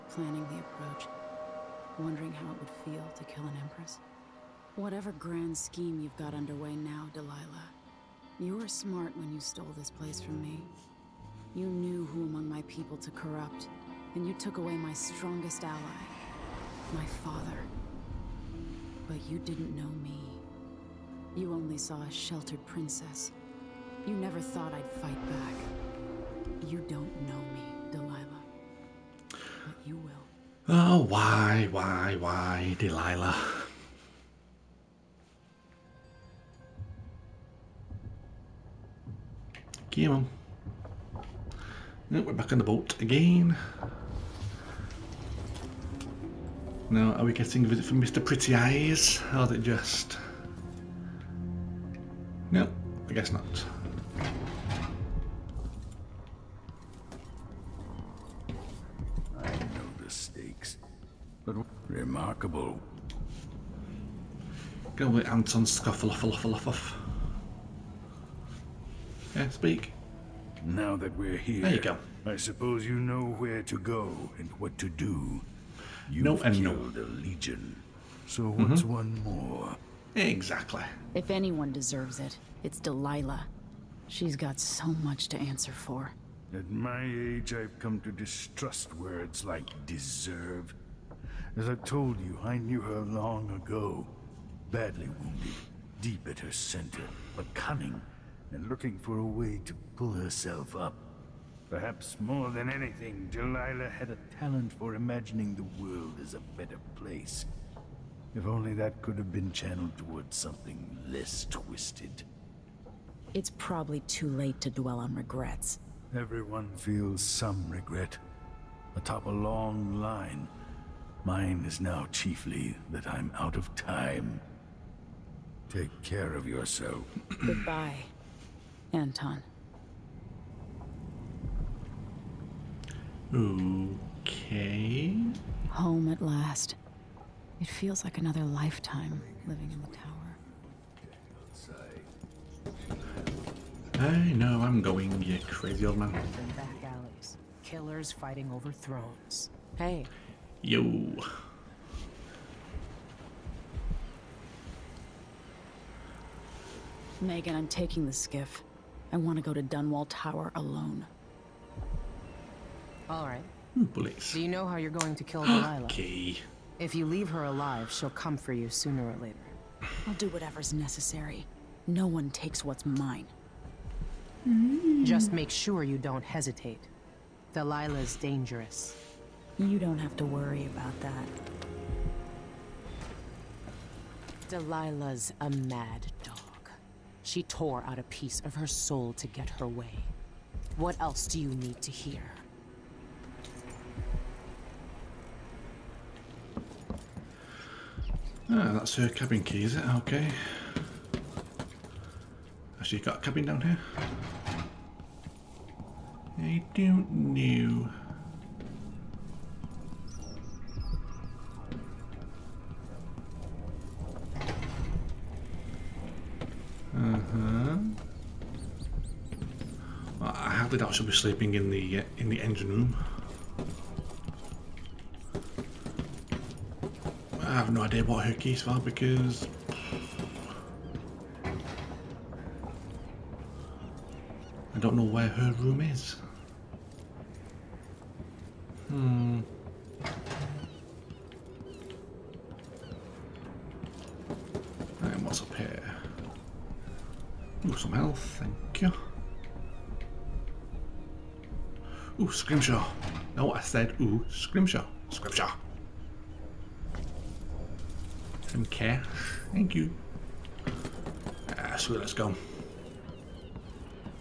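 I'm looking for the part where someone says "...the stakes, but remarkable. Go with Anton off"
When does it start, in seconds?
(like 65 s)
60 s.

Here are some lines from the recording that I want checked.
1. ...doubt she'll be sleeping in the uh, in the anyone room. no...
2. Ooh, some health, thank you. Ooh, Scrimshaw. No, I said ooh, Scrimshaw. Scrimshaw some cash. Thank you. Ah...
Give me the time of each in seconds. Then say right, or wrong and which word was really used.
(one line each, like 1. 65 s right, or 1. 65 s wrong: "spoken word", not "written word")
1. 220 s wrong: "engine", not "anyone"
2. 247 s right.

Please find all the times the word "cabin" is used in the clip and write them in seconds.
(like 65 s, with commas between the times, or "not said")
199 s, 203 s.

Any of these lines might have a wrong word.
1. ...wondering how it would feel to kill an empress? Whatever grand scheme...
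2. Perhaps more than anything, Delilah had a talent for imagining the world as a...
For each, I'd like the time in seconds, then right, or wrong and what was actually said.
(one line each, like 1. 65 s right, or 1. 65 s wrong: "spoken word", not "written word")
1. 1 s right
2. 101 s right.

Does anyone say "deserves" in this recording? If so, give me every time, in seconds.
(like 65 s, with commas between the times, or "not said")
81 s, 89 s.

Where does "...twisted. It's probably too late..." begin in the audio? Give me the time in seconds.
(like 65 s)
111 s.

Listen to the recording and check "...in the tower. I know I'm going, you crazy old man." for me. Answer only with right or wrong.
right.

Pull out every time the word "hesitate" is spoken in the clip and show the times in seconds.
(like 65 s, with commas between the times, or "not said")
176 s.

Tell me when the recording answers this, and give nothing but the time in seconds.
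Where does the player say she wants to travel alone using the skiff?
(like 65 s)
159 s.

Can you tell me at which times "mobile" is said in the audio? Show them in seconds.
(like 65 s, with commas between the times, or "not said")
not said.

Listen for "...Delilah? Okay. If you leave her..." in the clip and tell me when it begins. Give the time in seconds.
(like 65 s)
165 s.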